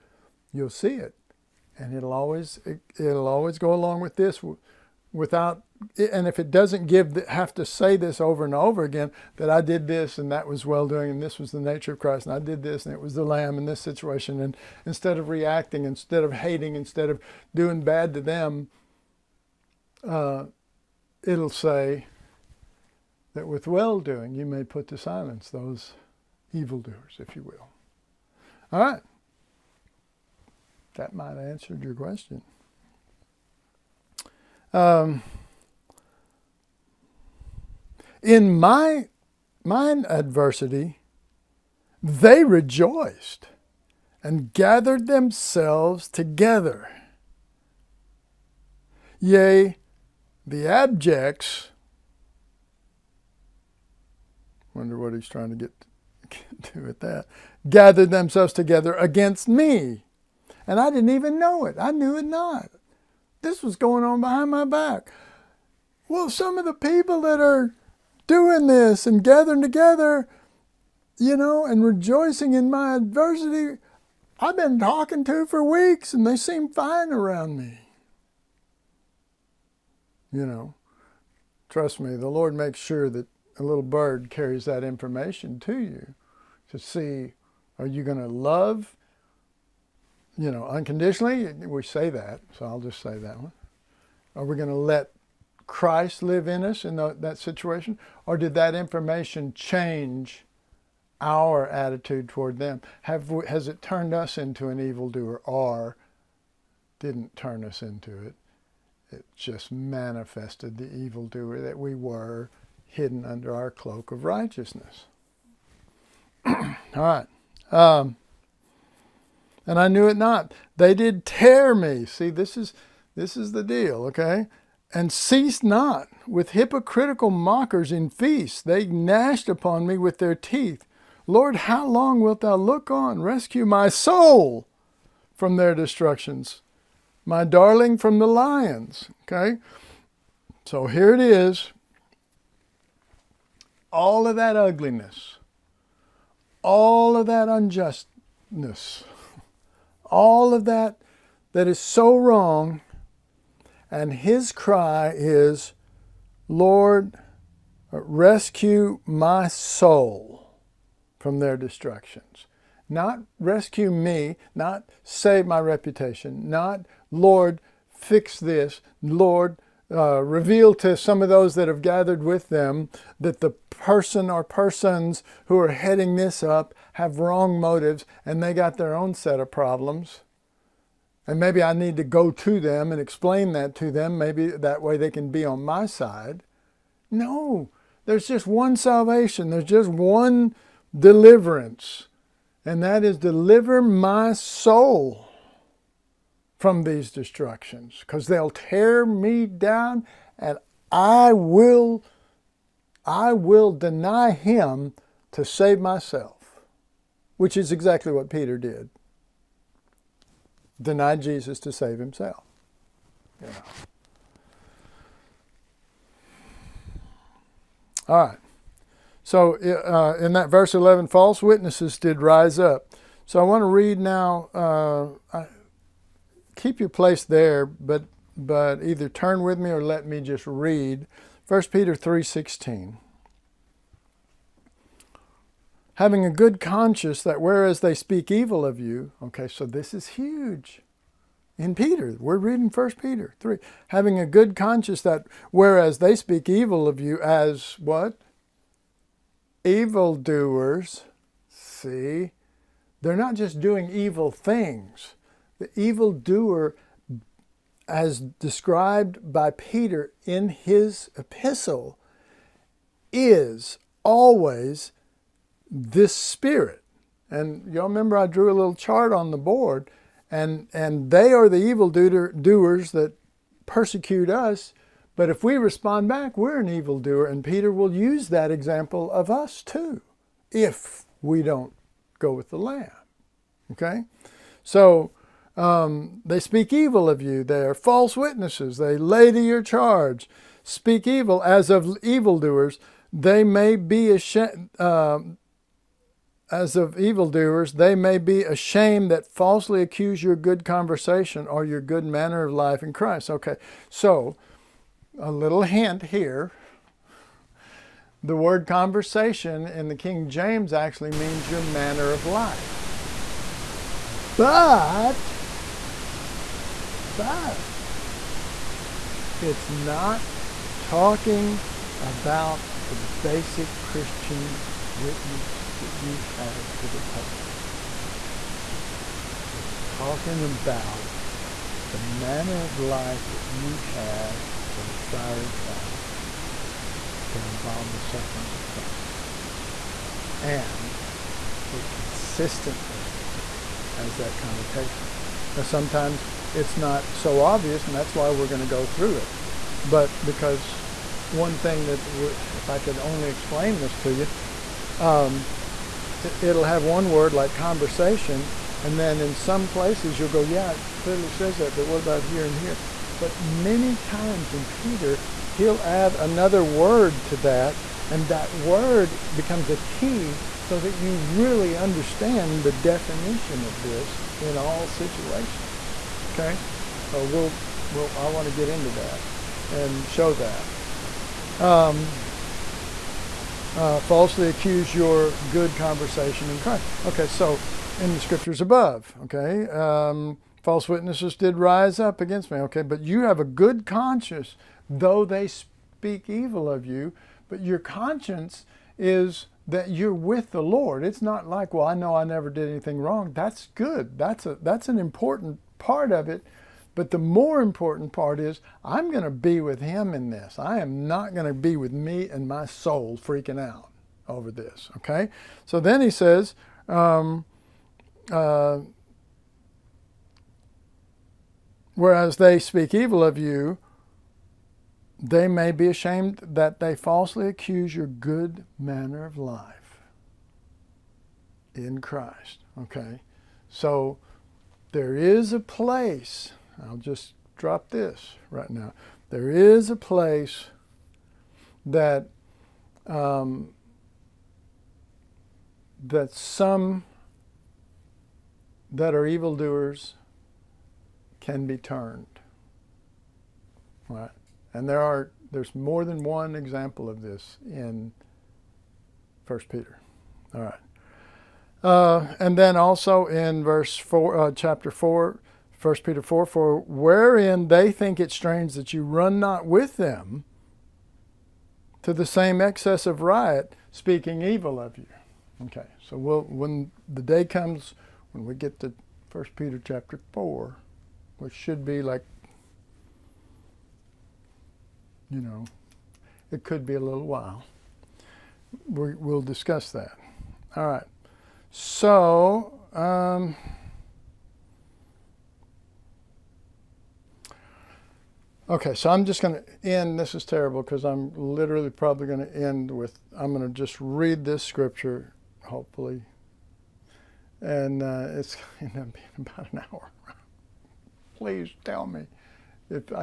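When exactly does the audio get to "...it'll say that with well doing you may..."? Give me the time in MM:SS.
00:21.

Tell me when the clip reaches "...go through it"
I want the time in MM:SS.
05:48.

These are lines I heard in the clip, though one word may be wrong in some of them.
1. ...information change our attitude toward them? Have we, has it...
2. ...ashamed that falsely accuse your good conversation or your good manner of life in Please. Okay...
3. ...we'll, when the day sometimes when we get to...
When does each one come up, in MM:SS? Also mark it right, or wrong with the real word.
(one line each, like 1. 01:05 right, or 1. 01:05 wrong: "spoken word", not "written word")
1. 01:38 right
2. 04:58 wrong: "Christ", not "Please"
3. 07:56 wrong: "comes", not "sometimes".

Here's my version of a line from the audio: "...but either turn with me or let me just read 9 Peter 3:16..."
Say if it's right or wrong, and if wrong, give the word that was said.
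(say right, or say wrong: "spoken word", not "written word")
wrong: "1", not "9".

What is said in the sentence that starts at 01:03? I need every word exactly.
This was going on behind my back.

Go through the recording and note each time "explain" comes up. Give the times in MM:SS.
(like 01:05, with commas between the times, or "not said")
03:02, 05:53.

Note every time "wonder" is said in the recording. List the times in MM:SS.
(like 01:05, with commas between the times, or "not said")
00:54.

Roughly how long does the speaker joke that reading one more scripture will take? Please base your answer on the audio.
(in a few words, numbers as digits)
about an hour.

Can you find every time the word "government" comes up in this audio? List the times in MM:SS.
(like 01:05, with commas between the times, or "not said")
not said.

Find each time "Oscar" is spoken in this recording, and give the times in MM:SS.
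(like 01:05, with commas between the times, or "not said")
not said.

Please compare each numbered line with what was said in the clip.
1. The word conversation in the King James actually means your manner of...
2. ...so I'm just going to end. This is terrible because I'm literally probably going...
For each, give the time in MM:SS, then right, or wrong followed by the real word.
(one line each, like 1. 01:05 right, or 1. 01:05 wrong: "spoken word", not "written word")
1. 05:08 right
2. 08:18 right.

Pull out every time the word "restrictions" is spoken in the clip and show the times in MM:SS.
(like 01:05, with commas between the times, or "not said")
not said.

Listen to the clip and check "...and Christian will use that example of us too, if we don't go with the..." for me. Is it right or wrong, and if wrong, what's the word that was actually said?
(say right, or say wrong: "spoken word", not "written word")
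wrong: "Peter", not "Christian".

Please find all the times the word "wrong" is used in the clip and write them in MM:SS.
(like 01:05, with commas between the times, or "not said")
02:32, 02:57, 06:42.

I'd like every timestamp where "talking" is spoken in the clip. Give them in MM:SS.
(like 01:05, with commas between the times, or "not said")
01:14, 05:20, 05:29.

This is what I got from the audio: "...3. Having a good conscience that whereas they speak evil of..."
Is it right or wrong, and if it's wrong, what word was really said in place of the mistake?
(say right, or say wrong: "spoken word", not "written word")
right.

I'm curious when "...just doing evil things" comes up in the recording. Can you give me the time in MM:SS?
04:13.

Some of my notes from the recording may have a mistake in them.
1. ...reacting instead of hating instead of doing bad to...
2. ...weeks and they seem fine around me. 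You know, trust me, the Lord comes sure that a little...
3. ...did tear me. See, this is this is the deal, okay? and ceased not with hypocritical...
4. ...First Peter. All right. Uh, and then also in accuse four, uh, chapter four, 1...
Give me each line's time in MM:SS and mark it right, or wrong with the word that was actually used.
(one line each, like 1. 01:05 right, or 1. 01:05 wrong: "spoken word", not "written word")
1. 00:15 right
2. 01:15 wrong: "makes", not "comes"
3. 02:00 right
4. 07:39 wrong: "verse", not "accuse".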